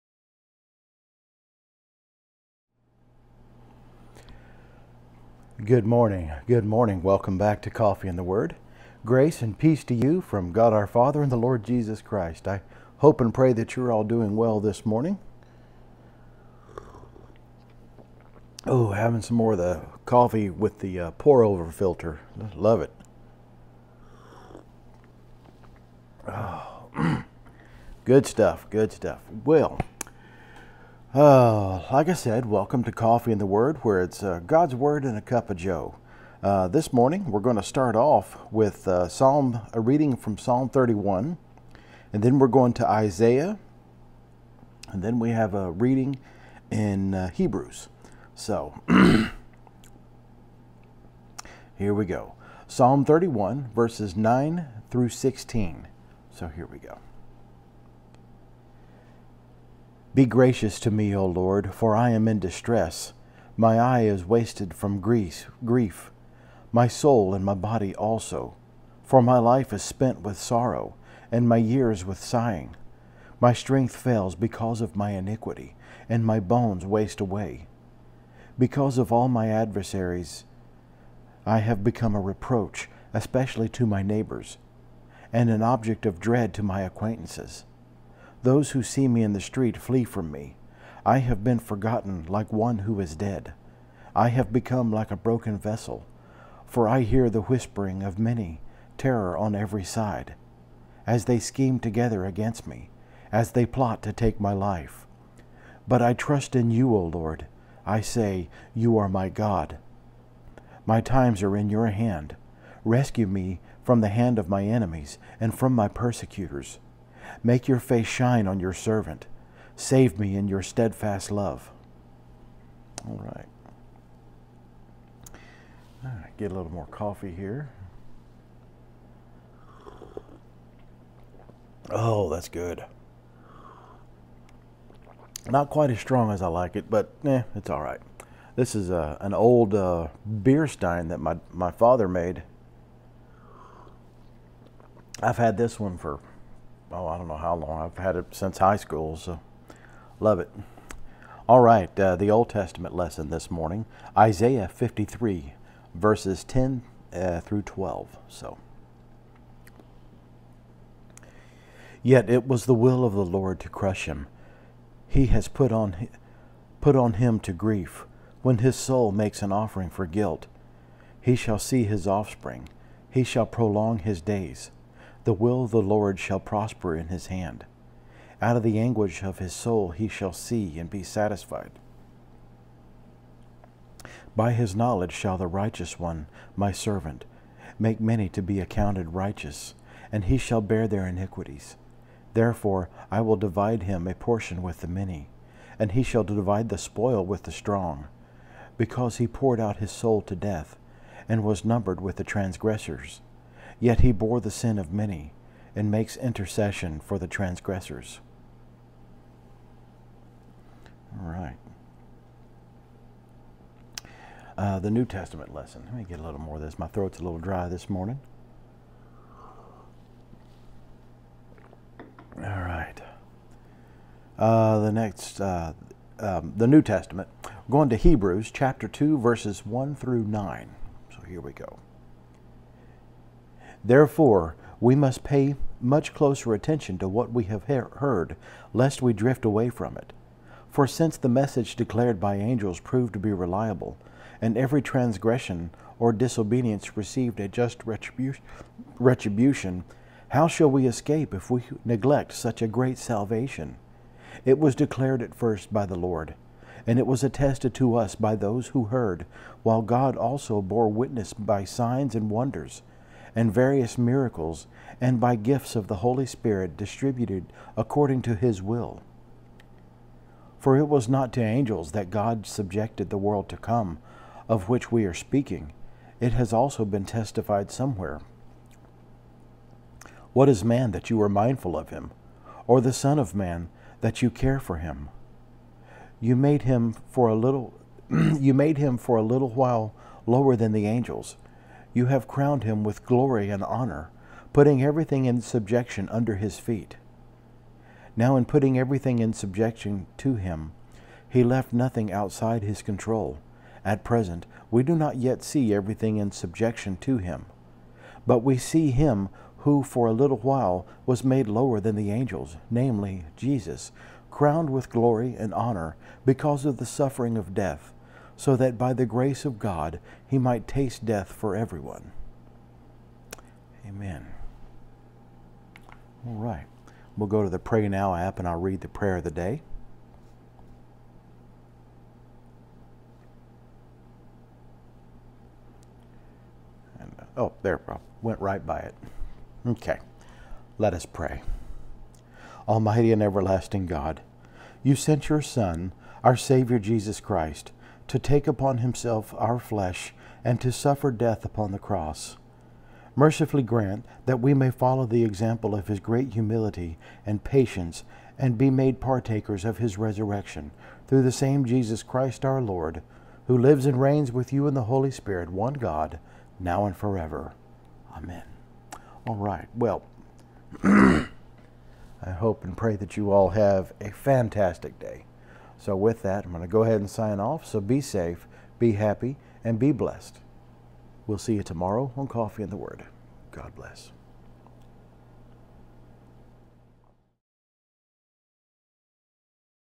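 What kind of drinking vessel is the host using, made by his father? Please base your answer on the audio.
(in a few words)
beer stein.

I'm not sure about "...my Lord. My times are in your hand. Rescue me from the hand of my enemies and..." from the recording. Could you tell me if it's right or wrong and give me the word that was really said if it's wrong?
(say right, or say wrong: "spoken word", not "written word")
wrong: "God", not "Lord".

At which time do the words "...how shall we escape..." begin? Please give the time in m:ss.
4:10.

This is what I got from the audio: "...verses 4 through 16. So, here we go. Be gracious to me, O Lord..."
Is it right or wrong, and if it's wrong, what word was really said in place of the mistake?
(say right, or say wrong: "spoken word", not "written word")
wrong: "9", not "4".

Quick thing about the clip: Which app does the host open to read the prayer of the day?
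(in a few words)
Pray Now.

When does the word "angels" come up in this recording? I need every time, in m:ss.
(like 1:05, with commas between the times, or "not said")
4:02, 4:31, 4:50, 5:12.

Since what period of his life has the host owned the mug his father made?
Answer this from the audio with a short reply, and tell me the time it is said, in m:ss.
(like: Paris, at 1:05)
high school, at 2:28.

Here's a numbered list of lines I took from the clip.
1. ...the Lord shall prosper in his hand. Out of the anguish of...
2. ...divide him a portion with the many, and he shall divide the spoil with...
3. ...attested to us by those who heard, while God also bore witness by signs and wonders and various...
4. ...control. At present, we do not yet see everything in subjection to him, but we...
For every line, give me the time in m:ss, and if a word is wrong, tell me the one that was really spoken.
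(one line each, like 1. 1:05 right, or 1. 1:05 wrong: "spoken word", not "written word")
1. 2:55 right
2. 3:13 right
3. 4:17 right
4. 5:02 right.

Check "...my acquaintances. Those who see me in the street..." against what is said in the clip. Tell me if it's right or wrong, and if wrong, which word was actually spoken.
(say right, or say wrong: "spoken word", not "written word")
right.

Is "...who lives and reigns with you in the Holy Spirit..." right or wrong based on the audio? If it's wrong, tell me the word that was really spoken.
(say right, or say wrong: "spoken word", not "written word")
right.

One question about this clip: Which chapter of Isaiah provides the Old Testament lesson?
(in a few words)
53.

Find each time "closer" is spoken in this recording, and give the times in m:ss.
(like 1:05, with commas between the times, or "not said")
3:56.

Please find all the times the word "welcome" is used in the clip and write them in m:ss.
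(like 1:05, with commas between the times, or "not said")
0:07, 0:32.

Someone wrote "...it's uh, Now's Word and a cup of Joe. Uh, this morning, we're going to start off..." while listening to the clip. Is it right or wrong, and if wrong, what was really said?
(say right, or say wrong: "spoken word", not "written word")
wrong: "God", not "Now".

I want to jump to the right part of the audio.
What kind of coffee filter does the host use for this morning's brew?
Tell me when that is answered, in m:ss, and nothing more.
0:21.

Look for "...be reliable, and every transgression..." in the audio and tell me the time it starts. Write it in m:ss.
4:03.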